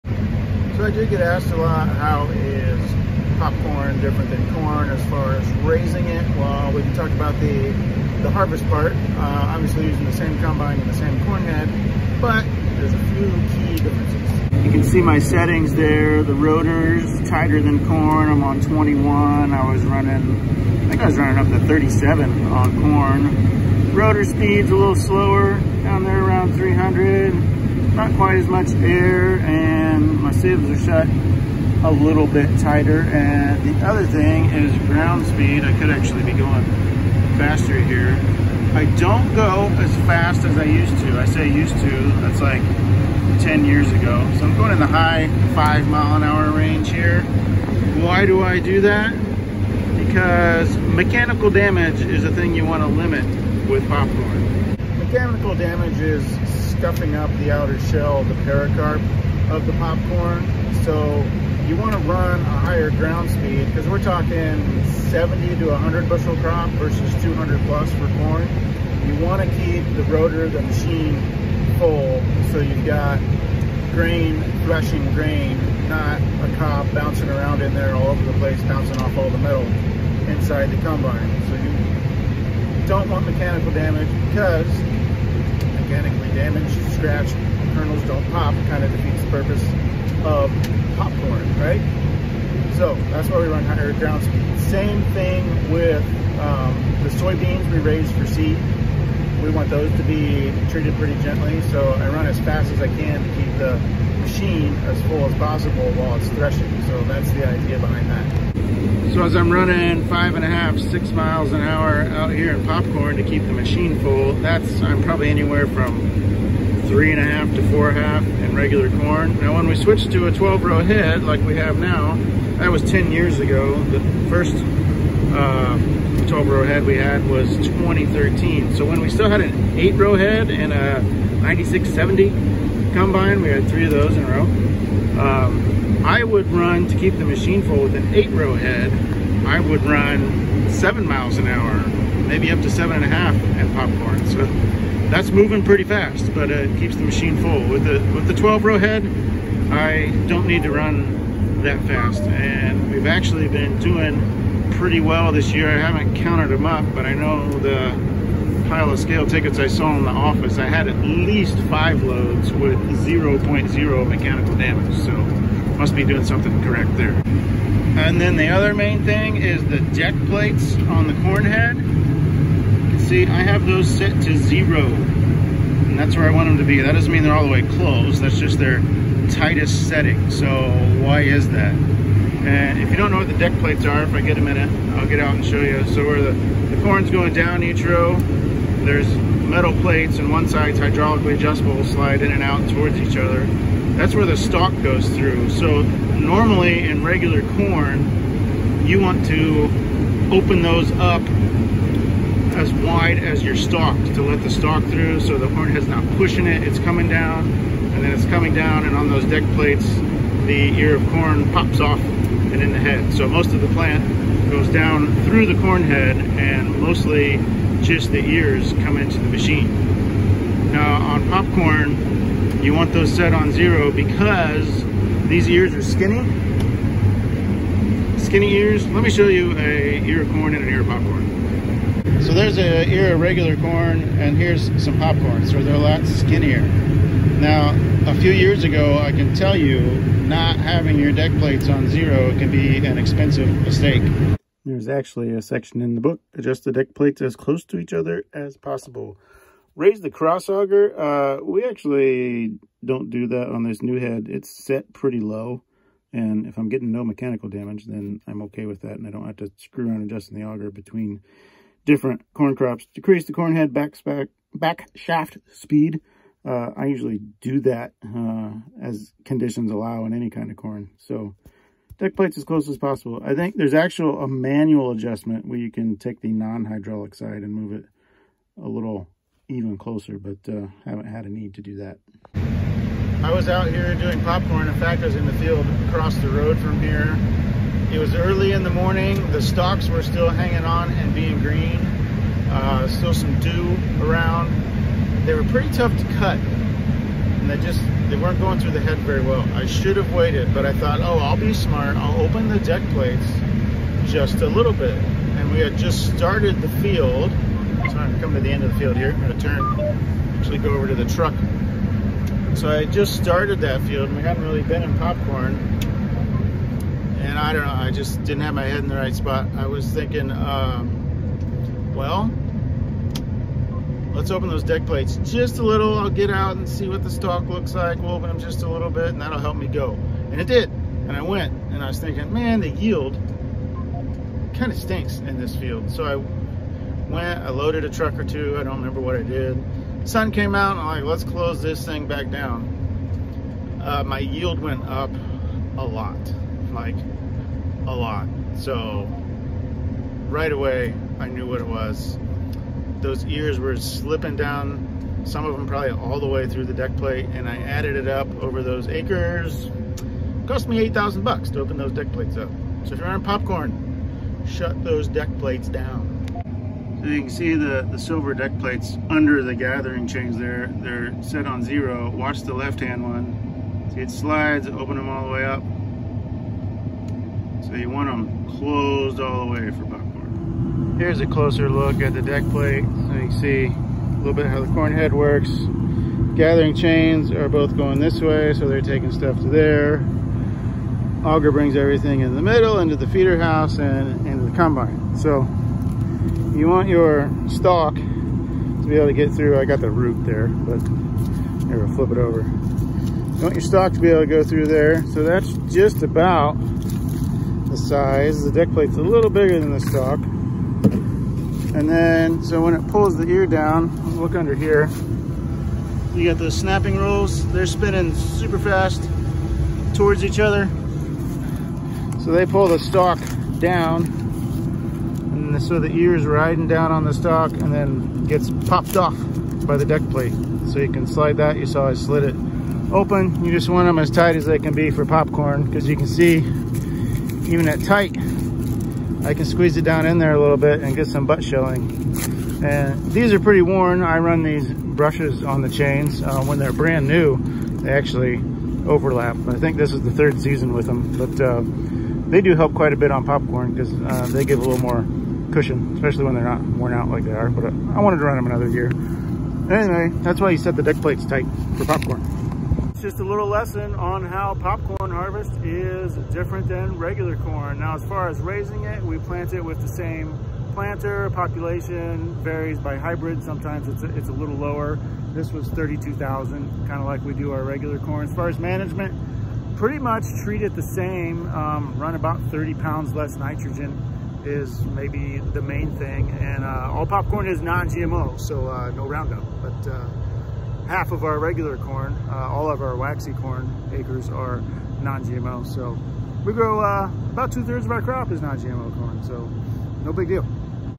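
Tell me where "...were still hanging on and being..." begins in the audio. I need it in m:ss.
4:49.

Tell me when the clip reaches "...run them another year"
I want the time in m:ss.
7:38.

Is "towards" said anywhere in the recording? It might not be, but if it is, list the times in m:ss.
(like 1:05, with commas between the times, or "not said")
3:12, 6:59.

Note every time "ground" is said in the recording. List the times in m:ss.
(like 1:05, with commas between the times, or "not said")
0:34, 1:02, 1:33.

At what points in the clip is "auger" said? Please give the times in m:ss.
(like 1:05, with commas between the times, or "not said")
4:10, 4:20, 6:31.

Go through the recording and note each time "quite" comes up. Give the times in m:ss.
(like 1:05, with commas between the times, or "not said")
0:28, 7:32.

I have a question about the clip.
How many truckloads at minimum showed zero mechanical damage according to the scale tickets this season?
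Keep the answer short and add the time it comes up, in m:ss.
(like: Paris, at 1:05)
5, at 2:40.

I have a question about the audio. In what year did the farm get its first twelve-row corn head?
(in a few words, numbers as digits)
2013.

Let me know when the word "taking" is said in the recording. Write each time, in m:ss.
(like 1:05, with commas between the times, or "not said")
6:28.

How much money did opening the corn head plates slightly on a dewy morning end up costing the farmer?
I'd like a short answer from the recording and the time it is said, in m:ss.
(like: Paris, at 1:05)
$8,000, at 6:00.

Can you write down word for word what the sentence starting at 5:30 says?
And I went and I was thinking, man, the yield kind of stinks in this field.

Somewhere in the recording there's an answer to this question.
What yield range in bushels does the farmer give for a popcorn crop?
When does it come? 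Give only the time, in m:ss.
1:05.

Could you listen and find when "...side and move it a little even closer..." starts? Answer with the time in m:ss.
4:37.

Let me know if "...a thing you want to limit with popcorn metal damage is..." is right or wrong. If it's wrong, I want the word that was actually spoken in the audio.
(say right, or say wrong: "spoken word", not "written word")
wrong: "mechanical", not "metal".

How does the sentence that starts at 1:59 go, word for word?
Now when we switched to a 12 row head like we have now, that was 10 years ago.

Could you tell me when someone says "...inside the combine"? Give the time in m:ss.
1:20.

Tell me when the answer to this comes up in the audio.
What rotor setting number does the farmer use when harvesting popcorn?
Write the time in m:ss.
0:18.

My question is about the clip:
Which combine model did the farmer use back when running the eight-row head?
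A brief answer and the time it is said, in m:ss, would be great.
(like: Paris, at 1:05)
9670, at 2:11.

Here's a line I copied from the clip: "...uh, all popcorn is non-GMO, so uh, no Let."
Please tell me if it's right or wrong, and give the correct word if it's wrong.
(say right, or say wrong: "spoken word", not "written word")
wrong: "Roundup", not "Let".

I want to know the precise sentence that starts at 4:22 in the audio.
Decrease the corn head back, back, back shaft speed.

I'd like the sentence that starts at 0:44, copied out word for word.
So I'm going in the high five mile an hour range here.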